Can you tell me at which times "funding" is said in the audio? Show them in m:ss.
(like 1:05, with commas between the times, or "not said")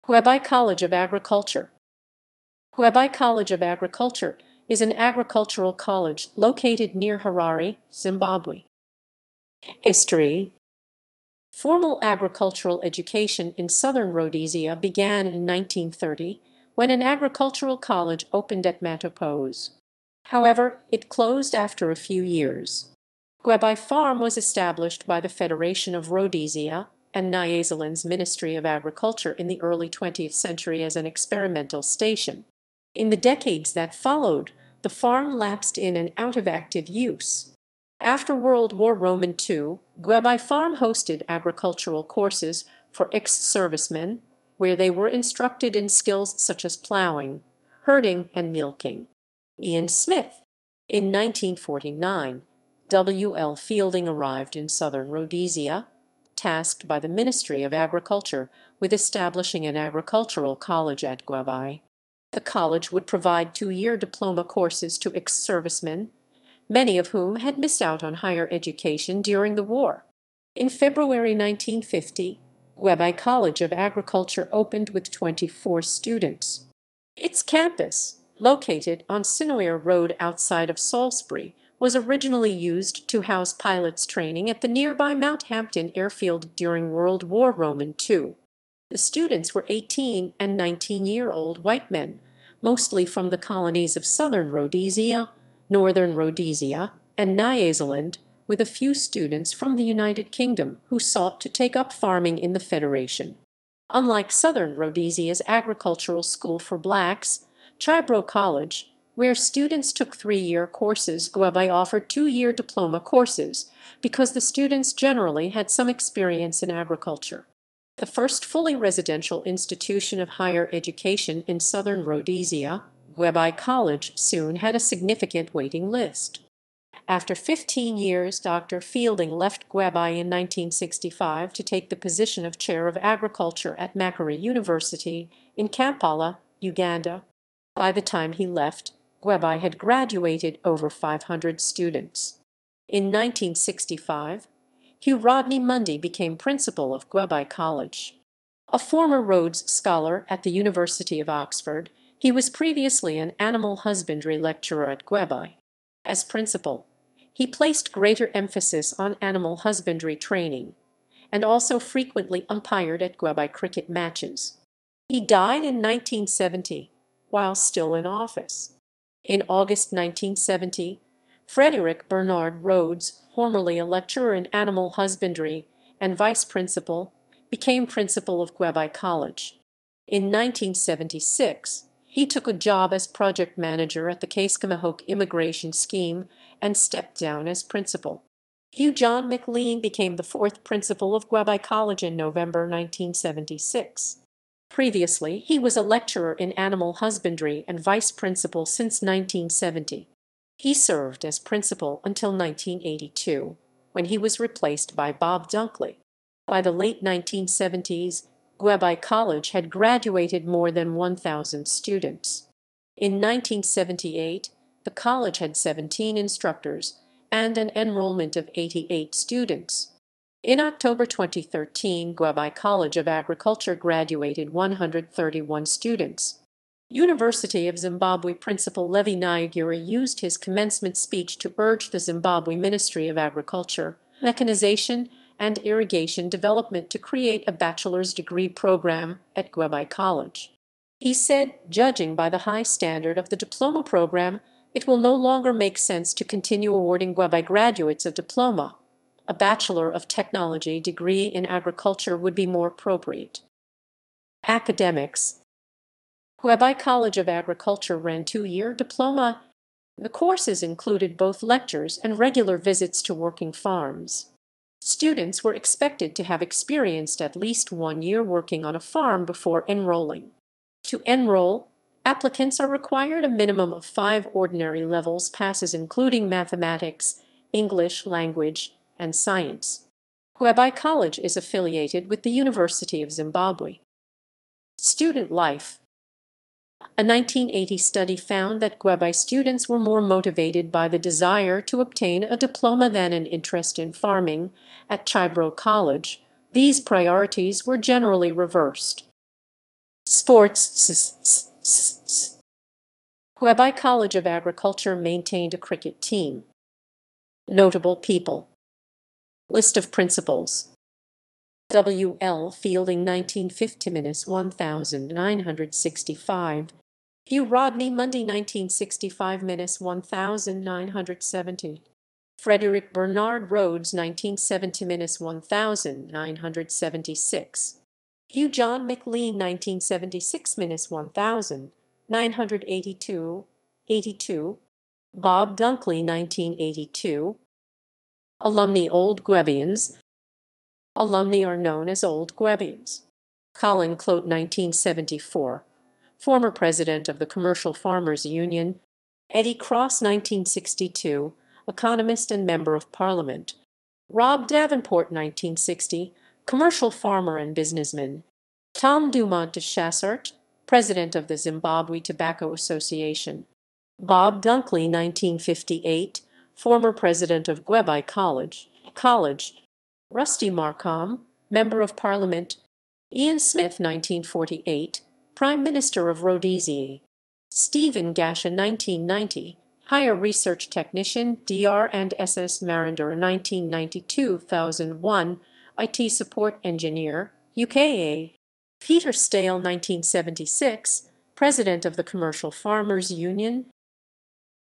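not said.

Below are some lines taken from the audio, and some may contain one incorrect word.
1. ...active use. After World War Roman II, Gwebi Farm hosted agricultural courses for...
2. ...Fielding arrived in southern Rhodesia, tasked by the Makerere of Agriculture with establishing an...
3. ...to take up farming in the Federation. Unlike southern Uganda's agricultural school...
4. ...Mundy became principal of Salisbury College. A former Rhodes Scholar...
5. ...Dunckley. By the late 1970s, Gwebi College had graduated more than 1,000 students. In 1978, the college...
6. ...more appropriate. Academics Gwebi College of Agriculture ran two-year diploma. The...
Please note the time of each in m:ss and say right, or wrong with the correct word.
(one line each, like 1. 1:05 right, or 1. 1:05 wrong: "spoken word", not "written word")
1. 0:36 right
2. 0:53 wrong: "Ministry", not "Makerere"
3. 1:41 wrong: "Rhodesia", not "Uganda"
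4. 2:25 wrong: "Gwebi", not "Salisbury"
5. 3:25 right
6. 4:12 right.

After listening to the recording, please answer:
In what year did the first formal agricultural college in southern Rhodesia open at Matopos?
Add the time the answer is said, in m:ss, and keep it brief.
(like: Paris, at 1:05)
1930, at 0:15.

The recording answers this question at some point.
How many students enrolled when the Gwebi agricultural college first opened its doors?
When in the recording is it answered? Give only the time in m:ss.
1:15.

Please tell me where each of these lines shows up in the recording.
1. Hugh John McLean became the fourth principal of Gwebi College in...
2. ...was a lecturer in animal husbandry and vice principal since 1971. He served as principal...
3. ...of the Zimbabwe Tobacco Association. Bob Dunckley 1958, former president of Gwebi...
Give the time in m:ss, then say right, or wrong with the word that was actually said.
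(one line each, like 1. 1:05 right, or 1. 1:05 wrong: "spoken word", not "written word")
1. 3:08 right
2. 3:15 wrong: "1970", not "1971"
3. 6:01 right.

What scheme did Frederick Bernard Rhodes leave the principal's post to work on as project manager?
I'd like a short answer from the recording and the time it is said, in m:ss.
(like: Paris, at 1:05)
Cascamahoke Immigration Scheme, at 3:04.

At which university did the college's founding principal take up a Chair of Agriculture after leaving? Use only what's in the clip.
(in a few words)
Makerere University.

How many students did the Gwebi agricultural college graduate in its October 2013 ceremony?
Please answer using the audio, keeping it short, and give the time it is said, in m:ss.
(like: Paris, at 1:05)
131, at 3:44.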